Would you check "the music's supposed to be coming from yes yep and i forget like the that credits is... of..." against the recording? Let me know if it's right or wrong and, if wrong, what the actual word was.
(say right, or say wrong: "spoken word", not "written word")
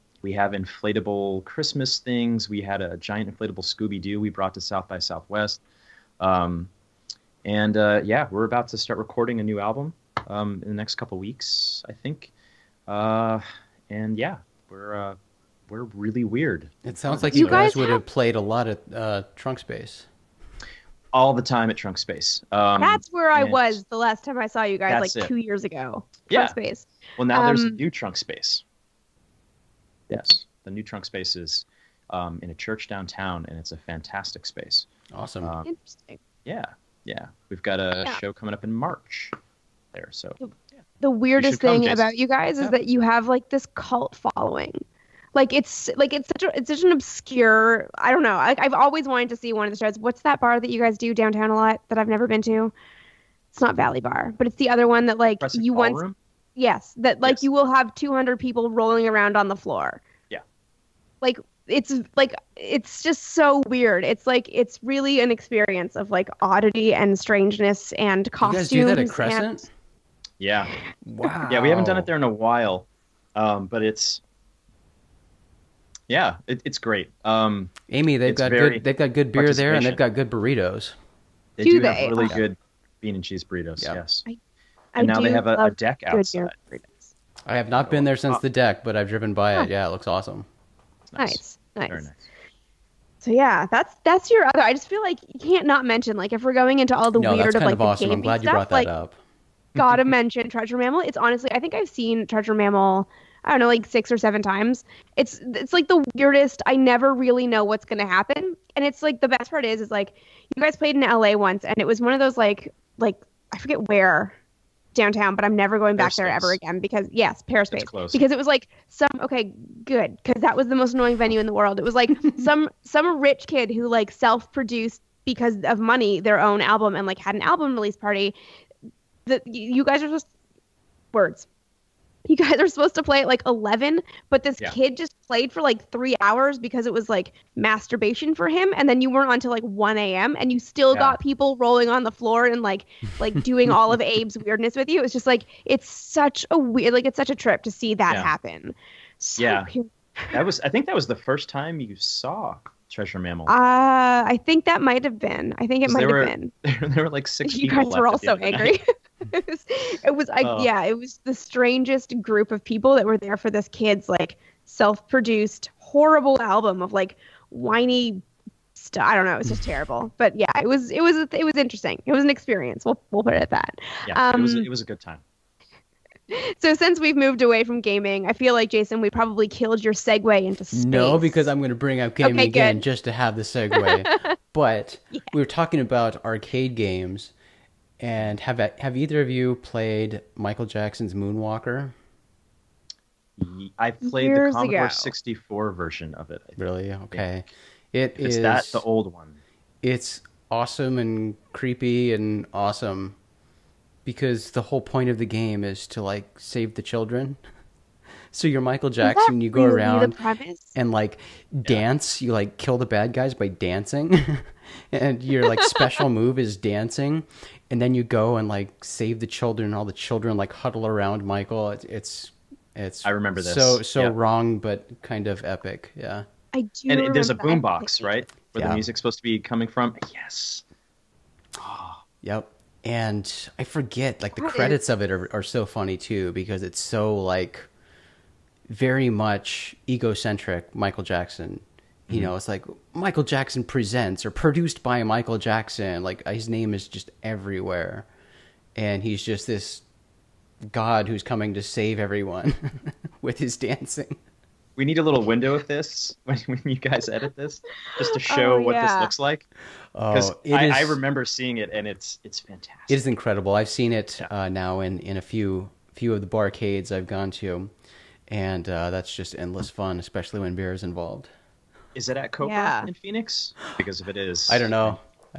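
right.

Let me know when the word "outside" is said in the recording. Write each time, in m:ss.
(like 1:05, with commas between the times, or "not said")
1:26.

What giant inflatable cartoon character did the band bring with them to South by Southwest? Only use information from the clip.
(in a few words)
Scooby Doo.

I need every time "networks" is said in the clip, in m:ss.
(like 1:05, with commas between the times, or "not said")
not said.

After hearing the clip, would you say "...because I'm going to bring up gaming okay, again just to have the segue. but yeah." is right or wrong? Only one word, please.
right.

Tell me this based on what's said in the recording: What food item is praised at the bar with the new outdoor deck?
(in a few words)
bean and cheese burritos.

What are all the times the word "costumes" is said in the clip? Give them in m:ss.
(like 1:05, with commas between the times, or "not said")
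1:08.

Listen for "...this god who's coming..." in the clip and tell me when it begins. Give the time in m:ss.
4:09.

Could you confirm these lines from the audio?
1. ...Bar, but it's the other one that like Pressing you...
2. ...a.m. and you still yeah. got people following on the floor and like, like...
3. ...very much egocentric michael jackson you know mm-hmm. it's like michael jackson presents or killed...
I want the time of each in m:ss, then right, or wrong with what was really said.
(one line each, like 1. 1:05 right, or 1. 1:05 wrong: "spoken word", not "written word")
1. 0:53 right
2. 2:19 wrong: "rolling", not "following"
3. 3:58 wrong: "produced", not "killed".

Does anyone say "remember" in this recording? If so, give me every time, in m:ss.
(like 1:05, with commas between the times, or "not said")
3:43, 4:20.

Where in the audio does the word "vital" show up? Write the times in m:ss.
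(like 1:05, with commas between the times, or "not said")
not said.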